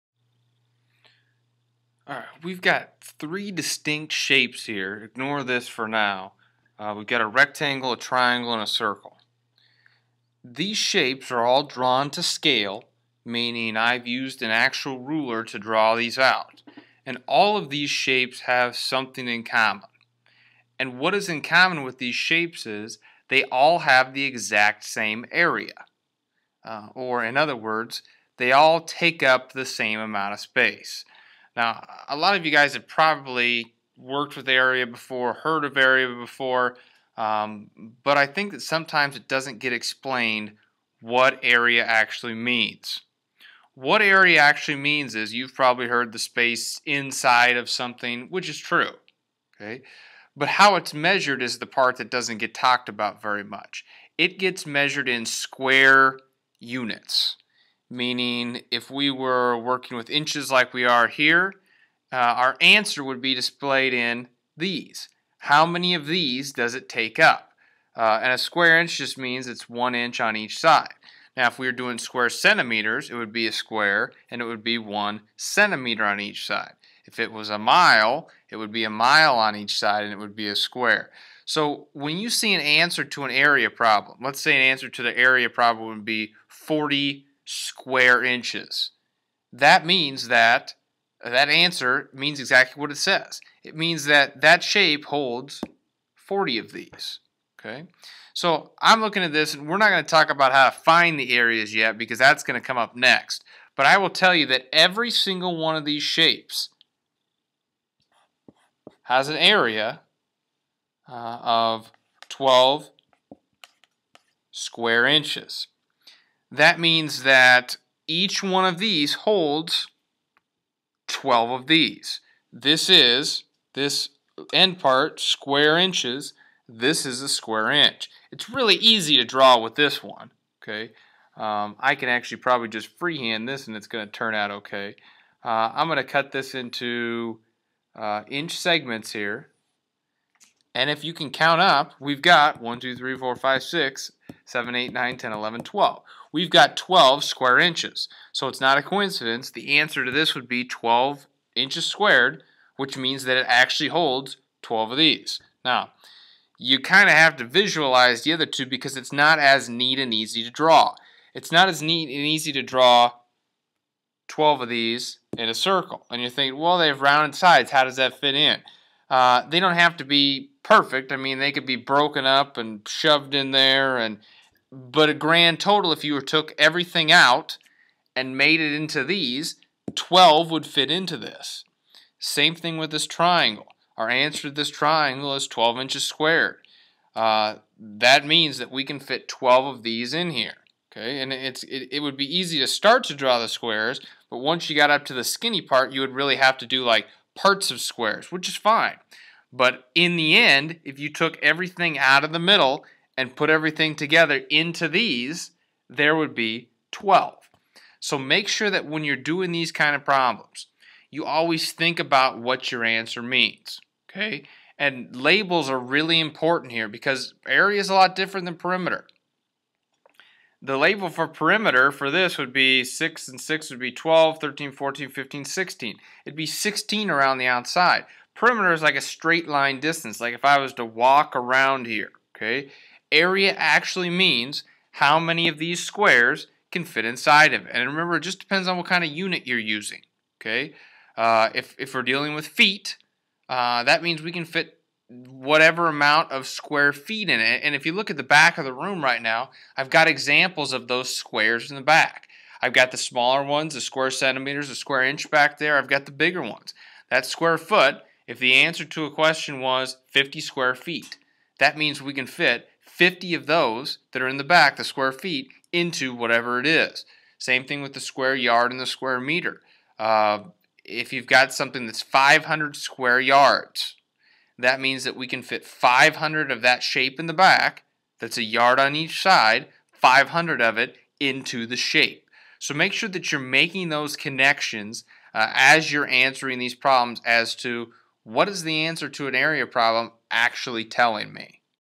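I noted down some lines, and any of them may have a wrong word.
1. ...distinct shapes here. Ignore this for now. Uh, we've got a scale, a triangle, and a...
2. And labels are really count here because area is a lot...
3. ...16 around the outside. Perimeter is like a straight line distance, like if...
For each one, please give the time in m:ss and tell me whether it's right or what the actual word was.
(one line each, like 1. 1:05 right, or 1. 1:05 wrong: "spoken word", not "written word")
1. 0:03 wrong: "rectangle", not "scale"
2. 3:34 wrong: "important", not "count"
3. 3:46 right.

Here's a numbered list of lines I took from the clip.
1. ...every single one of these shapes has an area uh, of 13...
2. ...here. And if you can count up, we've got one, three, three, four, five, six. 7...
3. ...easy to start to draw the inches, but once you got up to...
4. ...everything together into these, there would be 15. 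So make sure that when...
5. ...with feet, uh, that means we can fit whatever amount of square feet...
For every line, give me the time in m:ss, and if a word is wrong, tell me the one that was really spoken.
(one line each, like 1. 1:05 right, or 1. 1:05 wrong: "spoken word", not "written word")
1. 1:44 wrong: "12", not "13"
2. 2:19 wrong: "two", not "three"
3. 3:12 wrong: "squares", not "inches"
4. 3:23 wrong: "12", not "15"
5. 4:02 right.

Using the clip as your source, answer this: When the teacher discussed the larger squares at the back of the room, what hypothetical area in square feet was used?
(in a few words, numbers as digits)
50.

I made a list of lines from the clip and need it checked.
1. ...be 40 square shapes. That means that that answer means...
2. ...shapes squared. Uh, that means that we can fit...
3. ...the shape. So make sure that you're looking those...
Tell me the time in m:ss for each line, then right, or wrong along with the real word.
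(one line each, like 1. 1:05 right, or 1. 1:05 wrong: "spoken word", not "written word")
1. 1:26 wrong: "inches", not "shapes"
2. 3:05 wrong: "inches", not "shapes"
3. 4:41 wrong: "making", not "looking".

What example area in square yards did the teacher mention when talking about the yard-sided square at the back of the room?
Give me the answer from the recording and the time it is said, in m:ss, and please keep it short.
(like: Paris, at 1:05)
500 square yards, at 4:32.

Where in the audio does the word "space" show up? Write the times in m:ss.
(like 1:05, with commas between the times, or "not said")
0:30, 0:46.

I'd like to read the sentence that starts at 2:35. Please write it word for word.
Now, you kind of have to visualize the other two because it's not as neat and easy to draw.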